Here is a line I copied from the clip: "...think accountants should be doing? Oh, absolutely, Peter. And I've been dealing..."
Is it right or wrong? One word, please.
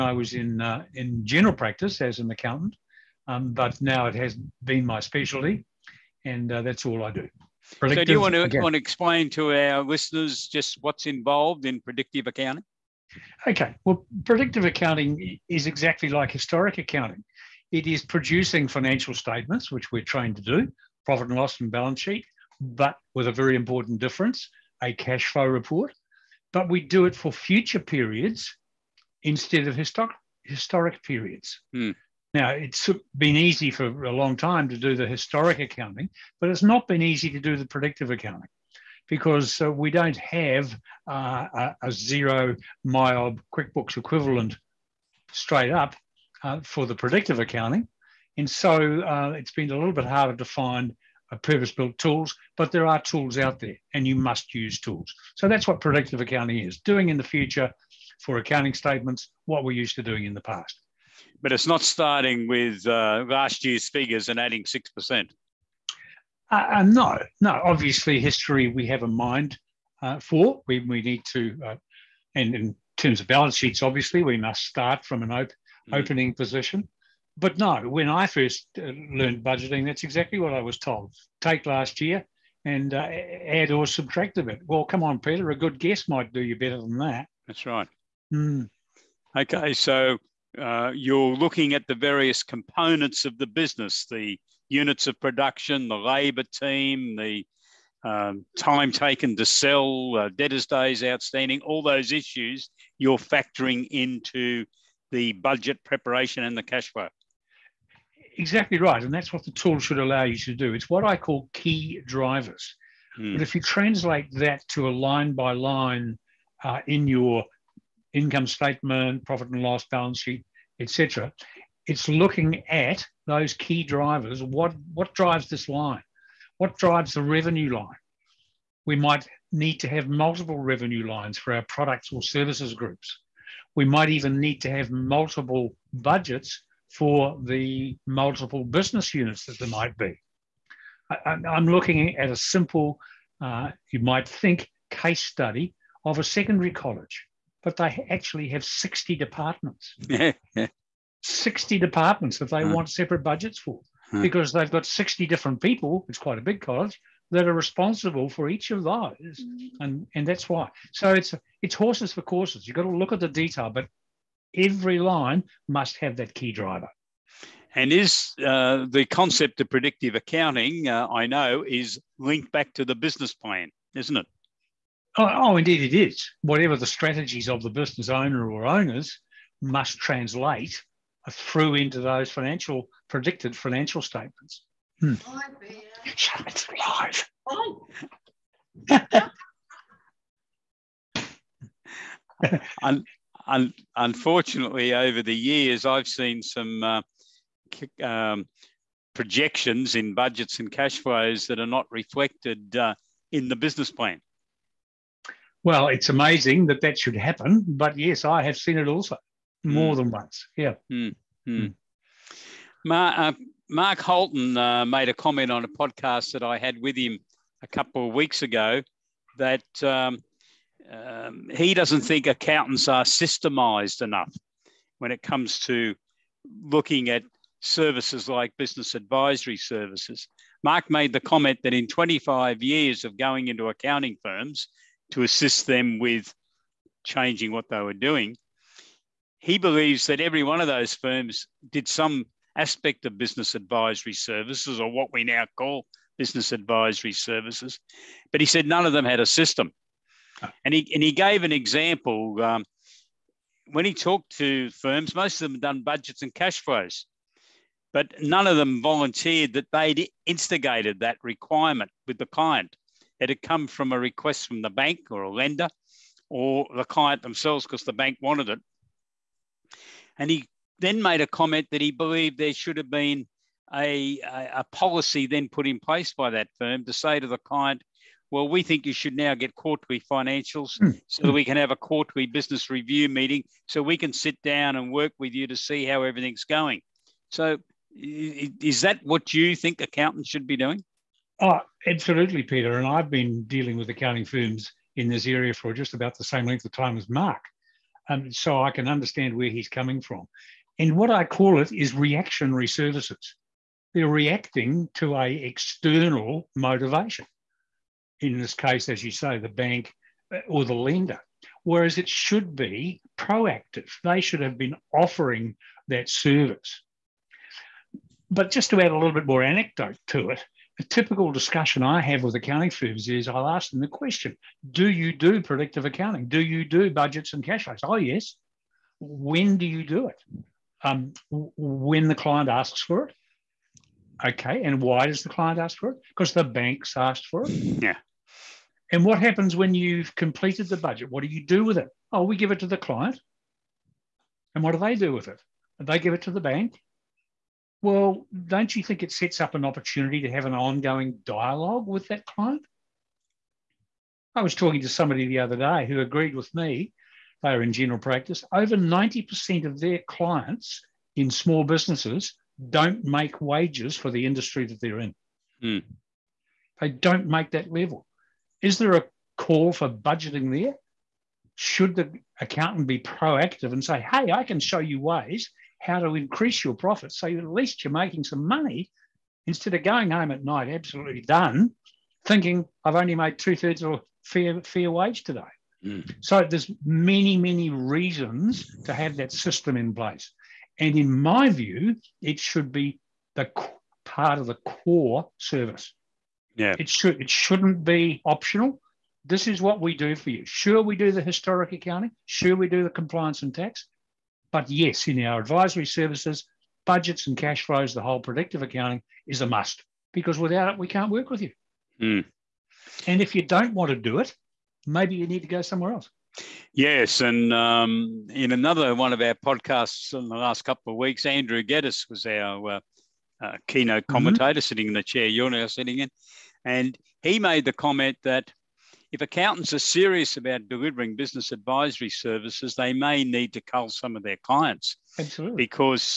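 right.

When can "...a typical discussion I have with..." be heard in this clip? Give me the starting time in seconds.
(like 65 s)
320 s.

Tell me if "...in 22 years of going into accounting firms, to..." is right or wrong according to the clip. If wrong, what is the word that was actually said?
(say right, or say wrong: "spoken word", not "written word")
wrong: "25", not "22".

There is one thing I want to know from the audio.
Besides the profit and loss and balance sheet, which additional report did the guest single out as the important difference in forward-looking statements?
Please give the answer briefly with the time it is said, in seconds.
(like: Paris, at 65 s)
Cash flow report, at 24 s.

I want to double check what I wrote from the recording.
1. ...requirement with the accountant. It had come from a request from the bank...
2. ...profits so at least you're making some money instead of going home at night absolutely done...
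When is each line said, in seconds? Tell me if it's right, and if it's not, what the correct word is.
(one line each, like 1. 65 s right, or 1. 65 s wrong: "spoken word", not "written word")
1. 261 s wrong: "client", not "accountant"
2. 376 s right.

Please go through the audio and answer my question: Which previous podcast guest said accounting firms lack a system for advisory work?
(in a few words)
Mark Holton.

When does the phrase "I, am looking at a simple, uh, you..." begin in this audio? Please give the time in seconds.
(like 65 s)
141 s.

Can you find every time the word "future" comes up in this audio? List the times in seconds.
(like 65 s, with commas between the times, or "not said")
27 s, 57 s.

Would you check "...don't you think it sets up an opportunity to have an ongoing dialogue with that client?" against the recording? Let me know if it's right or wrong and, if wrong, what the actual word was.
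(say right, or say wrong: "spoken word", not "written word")
right.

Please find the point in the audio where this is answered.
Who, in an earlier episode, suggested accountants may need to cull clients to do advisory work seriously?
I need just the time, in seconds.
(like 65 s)
421 s.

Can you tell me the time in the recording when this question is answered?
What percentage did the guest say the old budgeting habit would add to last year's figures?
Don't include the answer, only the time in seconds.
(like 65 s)
64 s.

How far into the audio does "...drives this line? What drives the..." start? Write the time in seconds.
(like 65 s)
125 s.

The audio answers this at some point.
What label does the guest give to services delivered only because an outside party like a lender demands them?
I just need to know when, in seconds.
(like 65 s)
301 s.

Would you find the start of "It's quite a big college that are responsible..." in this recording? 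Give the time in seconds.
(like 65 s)
156 s.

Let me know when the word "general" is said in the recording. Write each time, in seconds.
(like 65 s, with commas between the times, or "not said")
1 s, 357 s.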